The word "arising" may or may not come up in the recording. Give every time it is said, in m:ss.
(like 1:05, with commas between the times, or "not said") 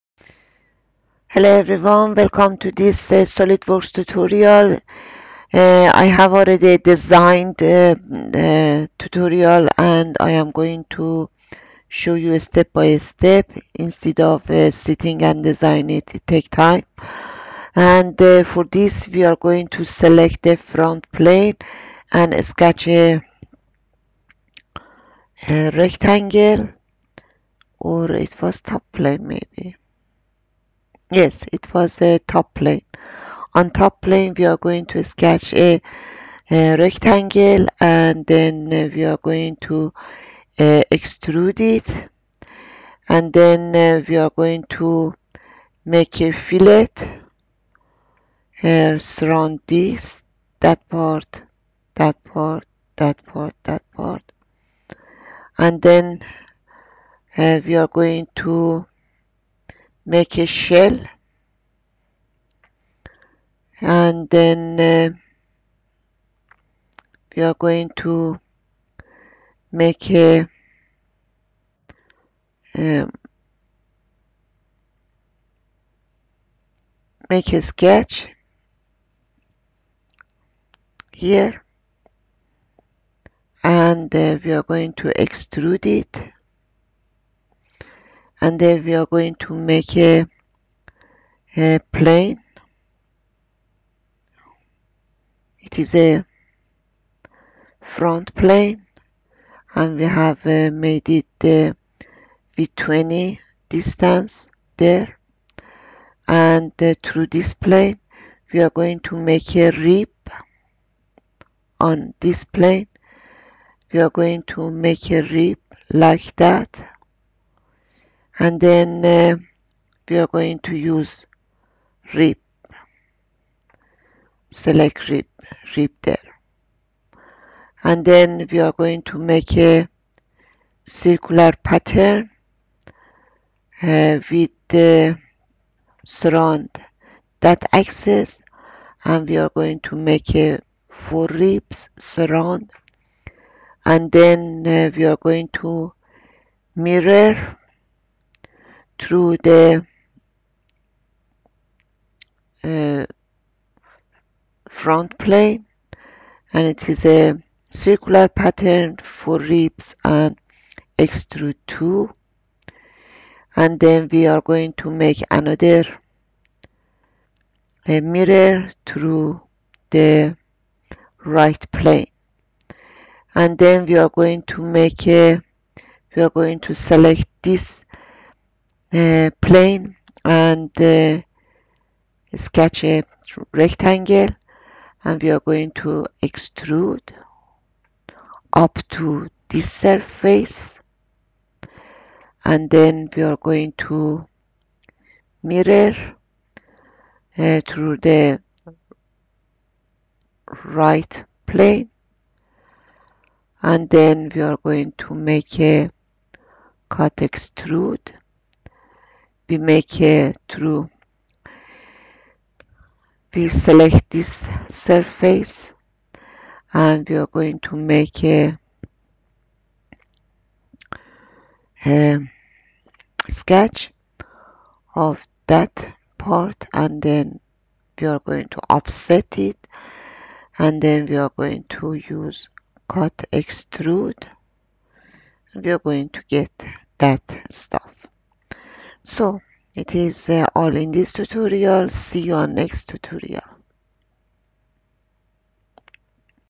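not said.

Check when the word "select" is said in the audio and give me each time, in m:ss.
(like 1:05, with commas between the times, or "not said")
0:19, 2:04, 2:56, 3:33.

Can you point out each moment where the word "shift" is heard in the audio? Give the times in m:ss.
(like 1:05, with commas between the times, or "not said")
not said.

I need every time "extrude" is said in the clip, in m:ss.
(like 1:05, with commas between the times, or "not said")
0:40, 1:25, 2:40, 3:06, 3:27, 3:53.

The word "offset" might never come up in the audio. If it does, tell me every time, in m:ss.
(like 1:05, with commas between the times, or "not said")
3:48.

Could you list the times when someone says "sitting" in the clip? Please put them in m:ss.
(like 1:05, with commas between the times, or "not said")
0:14.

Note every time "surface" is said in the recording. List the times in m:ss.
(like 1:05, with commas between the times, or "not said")
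3:09, 3:34.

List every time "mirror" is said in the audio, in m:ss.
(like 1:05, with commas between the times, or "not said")
2:26, 2:48, 3:15.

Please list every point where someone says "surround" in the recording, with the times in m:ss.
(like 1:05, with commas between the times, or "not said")
0:48, 2:16, 2:21.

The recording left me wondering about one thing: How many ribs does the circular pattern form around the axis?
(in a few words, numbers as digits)
4.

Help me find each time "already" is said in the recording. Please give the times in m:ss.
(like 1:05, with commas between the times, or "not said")
0:06.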